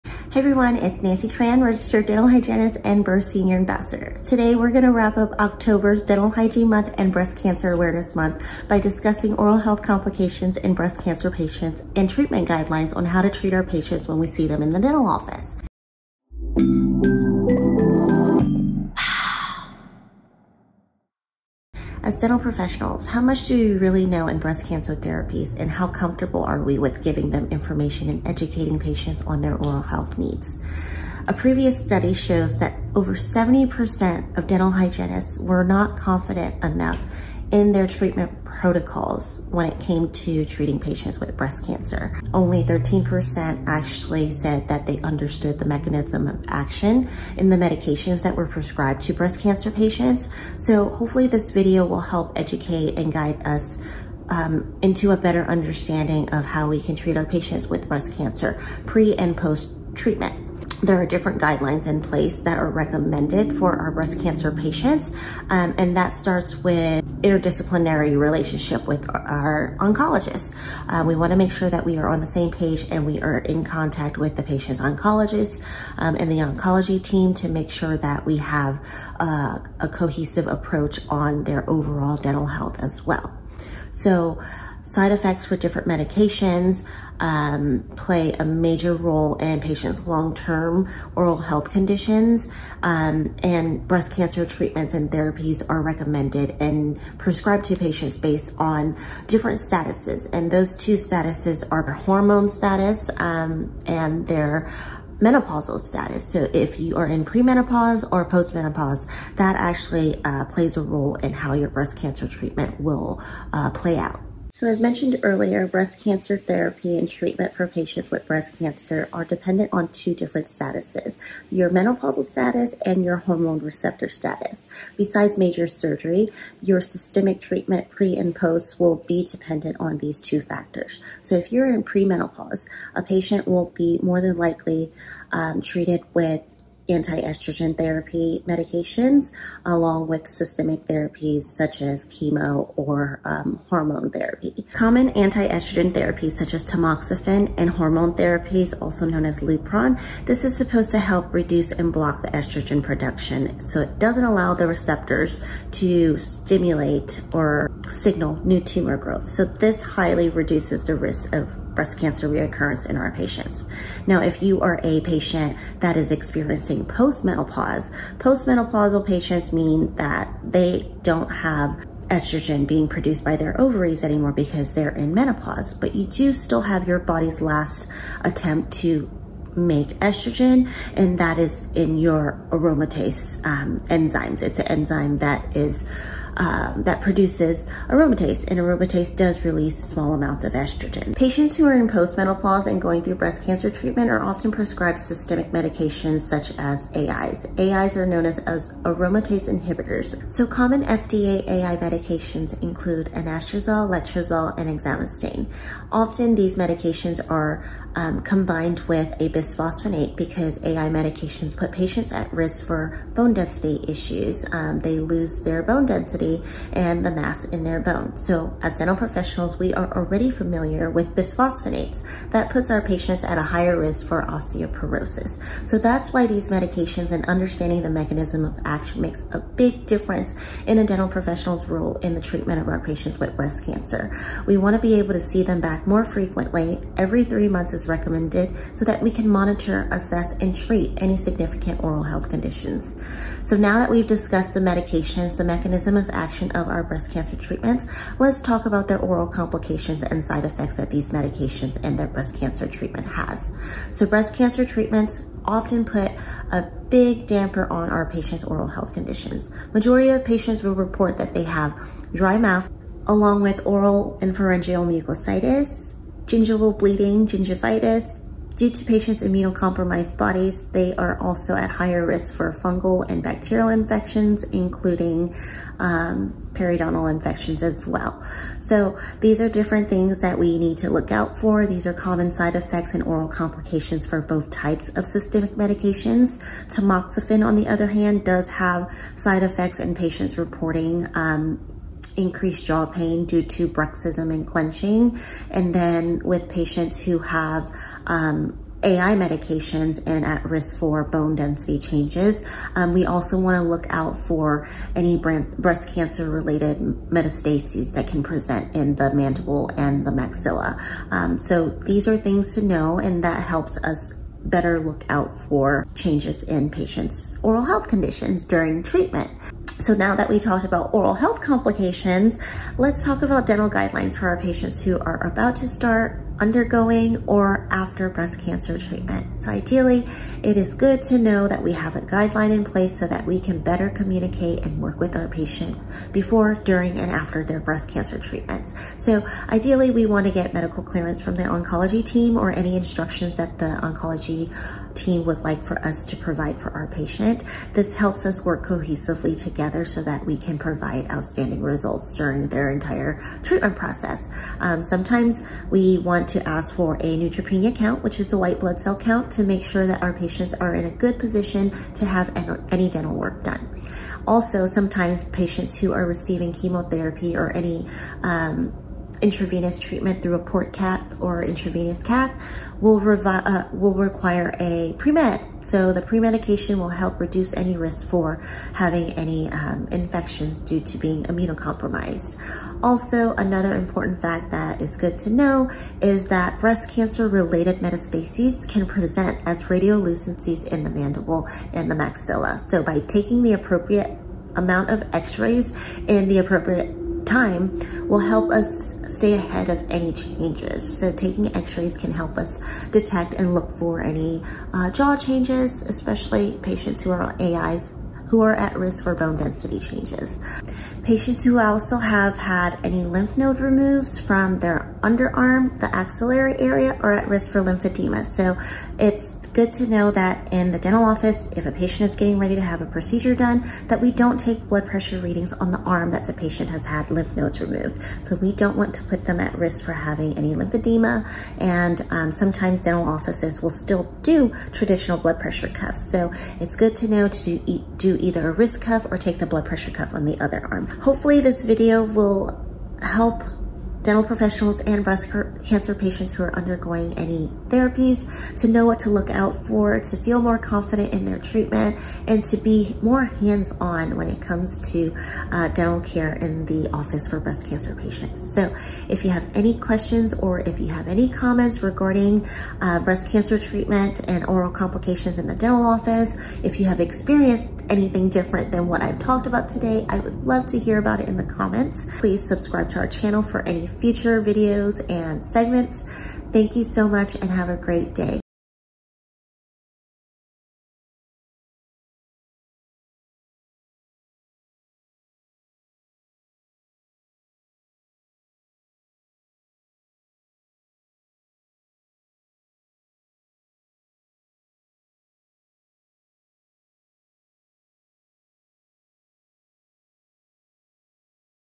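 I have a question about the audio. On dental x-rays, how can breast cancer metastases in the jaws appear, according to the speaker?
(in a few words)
radiolucencies.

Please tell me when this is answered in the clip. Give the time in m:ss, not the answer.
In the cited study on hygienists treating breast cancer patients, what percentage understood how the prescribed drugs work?
0:42.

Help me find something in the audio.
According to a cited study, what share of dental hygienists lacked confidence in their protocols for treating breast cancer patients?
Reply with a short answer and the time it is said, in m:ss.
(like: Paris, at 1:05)
over 70%, at 0:33.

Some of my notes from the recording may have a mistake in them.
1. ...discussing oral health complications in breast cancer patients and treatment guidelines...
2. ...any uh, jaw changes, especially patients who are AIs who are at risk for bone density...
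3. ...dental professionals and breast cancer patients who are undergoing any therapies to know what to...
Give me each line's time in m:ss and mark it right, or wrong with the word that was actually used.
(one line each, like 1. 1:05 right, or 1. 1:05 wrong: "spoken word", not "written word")
1. 0:08 right
2. 6:44 right
3. 7:24 right.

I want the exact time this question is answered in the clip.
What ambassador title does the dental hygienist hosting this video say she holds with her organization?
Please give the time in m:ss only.
0:03.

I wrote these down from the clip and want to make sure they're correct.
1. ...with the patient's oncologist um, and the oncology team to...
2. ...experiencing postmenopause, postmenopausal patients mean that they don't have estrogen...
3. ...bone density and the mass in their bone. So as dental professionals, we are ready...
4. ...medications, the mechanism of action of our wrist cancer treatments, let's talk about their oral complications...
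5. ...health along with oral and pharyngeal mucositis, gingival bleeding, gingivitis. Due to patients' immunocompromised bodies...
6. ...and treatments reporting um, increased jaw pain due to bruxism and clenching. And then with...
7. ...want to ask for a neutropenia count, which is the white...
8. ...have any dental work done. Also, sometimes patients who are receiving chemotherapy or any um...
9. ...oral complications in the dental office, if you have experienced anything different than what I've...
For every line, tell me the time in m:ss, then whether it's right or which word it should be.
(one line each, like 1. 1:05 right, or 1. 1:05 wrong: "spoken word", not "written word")
1. 1:14 right
2. 2:46 right
3. 3:35 wrong: "already", not "ready"
4. 4:04 wrong: "breast", not "wrist"
5. 4:22 wrong: "mouth", not "health"
6. 4:49 wrong: "patients", not "treatments"
7. 5:55 right
8. 6:02 right
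9. 7:44 right.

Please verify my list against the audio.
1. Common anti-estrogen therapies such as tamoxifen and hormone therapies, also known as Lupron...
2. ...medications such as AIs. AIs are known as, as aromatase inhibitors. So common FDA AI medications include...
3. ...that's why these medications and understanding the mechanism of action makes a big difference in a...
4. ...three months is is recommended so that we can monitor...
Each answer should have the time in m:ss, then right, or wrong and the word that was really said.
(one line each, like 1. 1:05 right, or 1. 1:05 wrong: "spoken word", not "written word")
1. 2:24 right
2. 3:15 right
3. 3:45 right
4. 3:57 right.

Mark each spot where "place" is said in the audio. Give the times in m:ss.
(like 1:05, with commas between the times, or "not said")
1:02, 5:32.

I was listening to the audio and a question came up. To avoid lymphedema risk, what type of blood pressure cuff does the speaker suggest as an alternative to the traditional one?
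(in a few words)
wrist cuff.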